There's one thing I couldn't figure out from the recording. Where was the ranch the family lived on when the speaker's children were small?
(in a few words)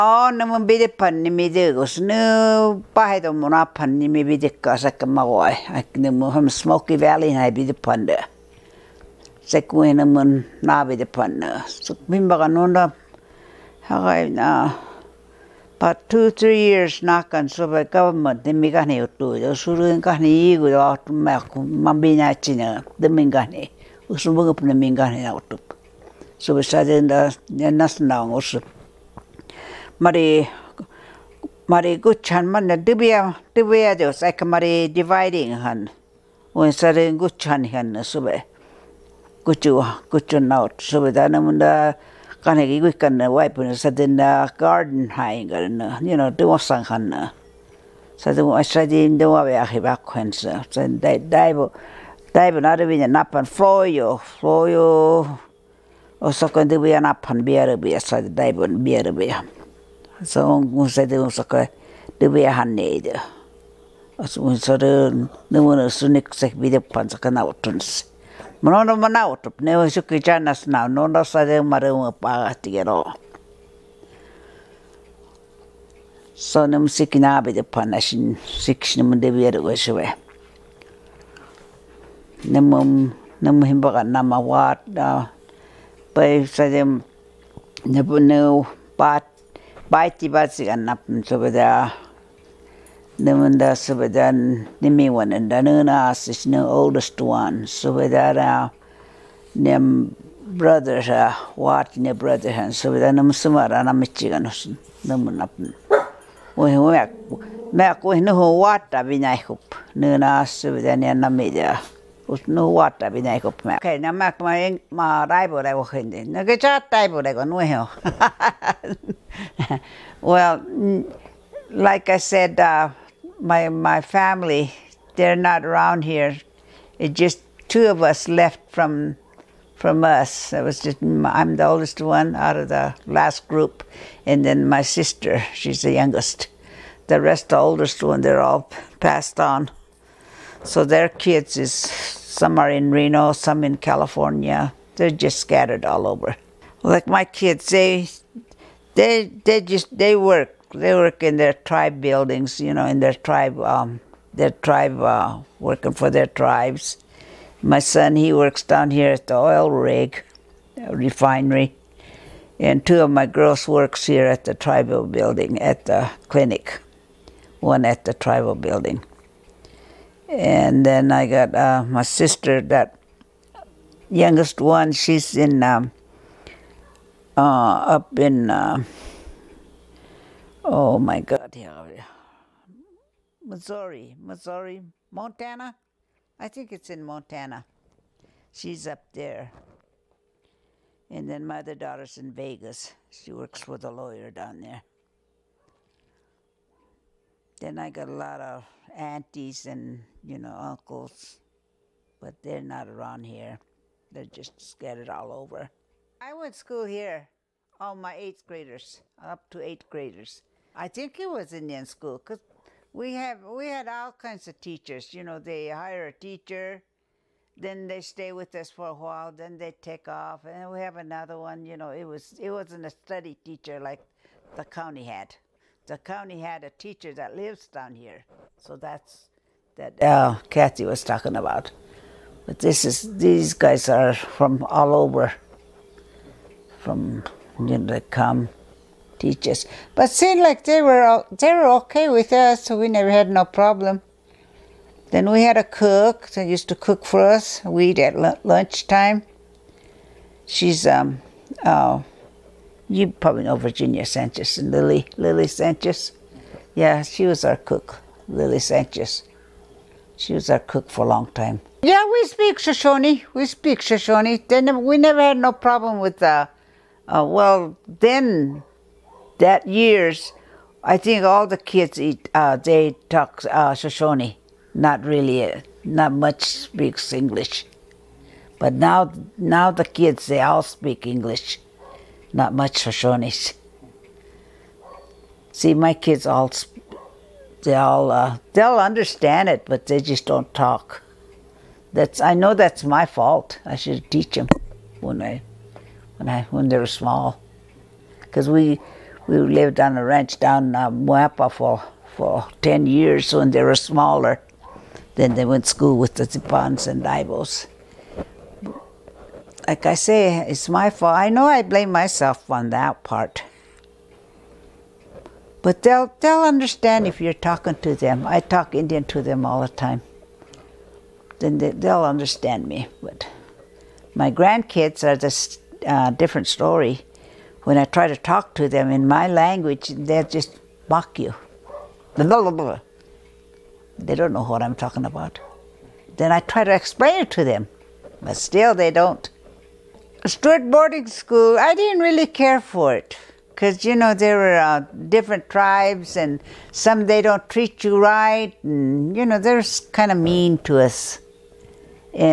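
Moapa.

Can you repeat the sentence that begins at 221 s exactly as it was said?
You know, it was it wasn't a study teacher like the county had the county had a teacher that lives down here.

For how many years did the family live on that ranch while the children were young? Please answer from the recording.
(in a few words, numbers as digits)
10.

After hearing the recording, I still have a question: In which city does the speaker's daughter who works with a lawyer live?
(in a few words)
Vegas.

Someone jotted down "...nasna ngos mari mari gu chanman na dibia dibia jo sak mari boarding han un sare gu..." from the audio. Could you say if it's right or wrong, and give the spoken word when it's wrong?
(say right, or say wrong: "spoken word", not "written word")
wrong: "dividing", not "boarding".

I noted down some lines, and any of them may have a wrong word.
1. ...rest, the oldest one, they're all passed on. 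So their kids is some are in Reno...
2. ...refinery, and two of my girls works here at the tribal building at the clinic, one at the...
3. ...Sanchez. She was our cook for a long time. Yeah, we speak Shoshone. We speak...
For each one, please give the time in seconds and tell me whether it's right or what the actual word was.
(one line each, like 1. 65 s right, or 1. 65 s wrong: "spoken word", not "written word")
1. 137 s right
2. 160 s right
3. 258 s right.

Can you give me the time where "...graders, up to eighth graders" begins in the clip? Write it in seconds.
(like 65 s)
208 s.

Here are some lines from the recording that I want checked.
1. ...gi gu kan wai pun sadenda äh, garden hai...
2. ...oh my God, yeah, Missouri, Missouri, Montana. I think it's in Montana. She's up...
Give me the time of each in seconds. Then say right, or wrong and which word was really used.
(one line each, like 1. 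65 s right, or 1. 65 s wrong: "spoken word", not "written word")
1. 42 s right
2. 180 s right.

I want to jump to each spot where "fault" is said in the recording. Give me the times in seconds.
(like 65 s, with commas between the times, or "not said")
293 s, 310 s.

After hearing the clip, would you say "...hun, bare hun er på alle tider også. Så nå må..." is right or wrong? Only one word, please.
right.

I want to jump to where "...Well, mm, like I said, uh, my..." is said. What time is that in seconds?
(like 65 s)
120 s.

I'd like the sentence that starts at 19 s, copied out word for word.
Jo suruin kahni igu jo ahtu mea kun mambina chine.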